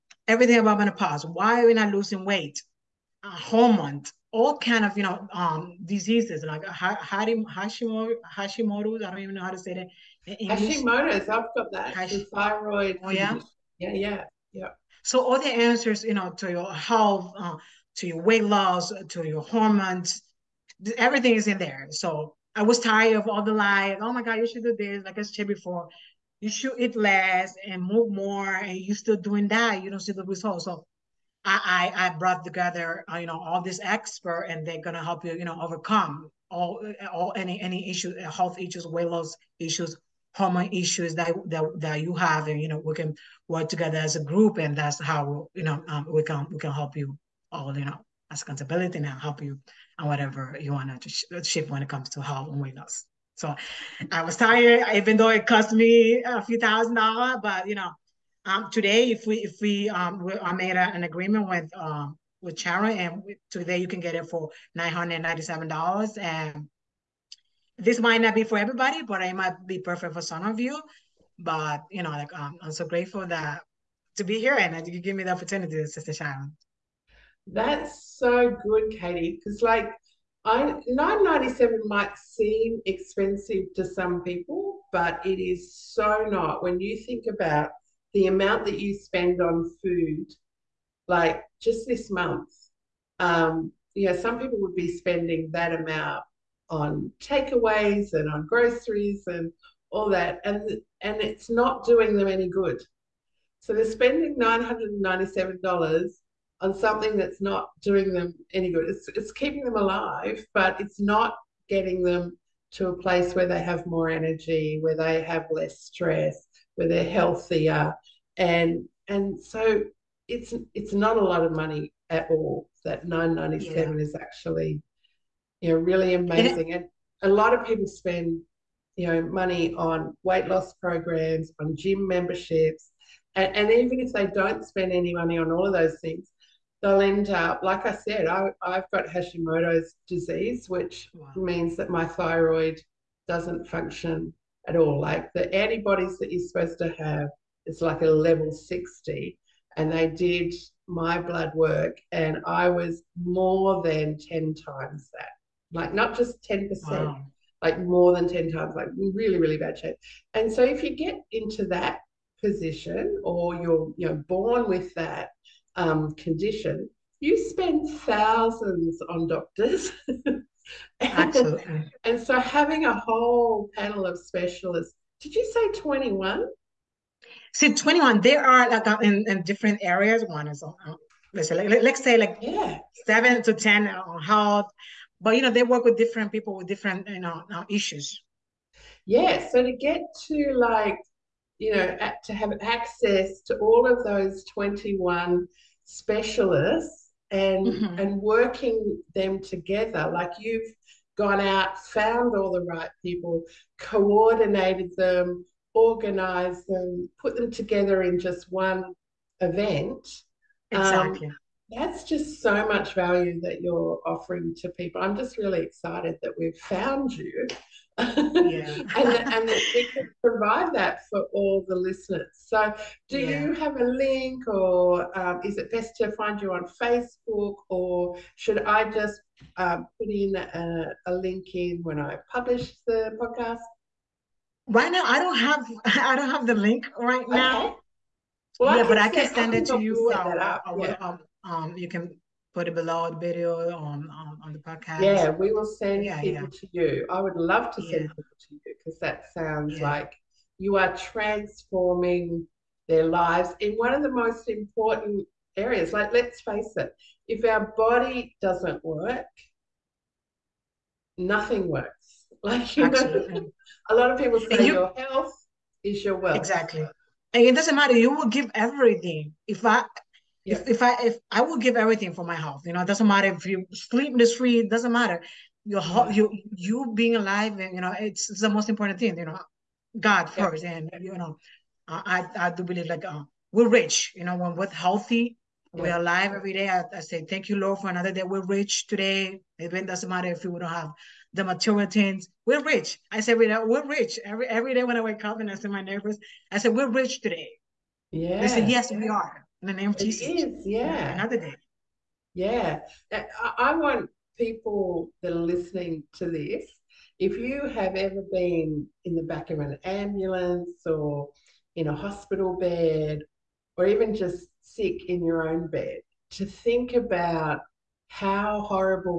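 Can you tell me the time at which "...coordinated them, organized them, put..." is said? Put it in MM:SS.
03:23.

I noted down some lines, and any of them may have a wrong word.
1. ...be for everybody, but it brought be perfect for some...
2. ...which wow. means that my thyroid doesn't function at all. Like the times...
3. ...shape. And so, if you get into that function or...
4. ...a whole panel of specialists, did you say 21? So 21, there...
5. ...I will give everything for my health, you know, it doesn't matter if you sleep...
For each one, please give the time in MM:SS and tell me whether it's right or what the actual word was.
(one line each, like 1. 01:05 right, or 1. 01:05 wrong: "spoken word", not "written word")
1. 01:08 wrong: "might", not "brought"
2. 02:20 wrong: "antibodies", not "times"
3. 02:39 wrong: "position", not "function"
4. 02:52 right
5. 04:31 right.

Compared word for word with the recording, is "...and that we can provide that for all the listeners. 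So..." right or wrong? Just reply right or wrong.
right.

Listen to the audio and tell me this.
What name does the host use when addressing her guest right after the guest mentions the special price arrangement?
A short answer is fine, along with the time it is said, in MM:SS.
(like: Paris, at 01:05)
Katy, at 01:18.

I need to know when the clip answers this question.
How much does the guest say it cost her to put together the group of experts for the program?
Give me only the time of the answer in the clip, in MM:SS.
00:56.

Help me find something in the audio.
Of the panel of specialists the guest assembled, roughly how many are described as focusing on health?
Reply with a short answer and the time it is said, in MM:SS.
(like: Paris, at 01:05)
7 to 10, at 03:03.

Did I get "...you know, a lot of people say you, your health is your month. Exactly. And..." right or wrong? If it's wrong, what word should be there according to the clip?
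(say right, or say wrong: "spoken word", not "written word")
wrong: "wealth", not "month".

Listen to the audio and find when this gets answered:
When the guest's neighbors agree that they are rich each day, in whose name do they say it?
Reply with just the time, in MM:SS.
05:00.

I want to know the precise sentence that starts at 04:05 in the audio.
Yeah, we will send yeah, people yeah.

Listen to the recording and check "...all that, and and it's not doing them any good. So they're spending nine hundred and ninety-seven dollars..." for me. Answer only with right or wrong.
right.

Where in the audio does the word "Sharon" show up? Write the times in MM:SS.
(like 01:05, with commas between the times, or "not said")
01:02, 01:16.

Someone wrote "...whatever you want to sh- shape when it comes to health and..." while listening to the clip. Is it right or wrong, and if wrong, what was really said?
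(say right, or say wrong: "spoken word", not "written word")
right.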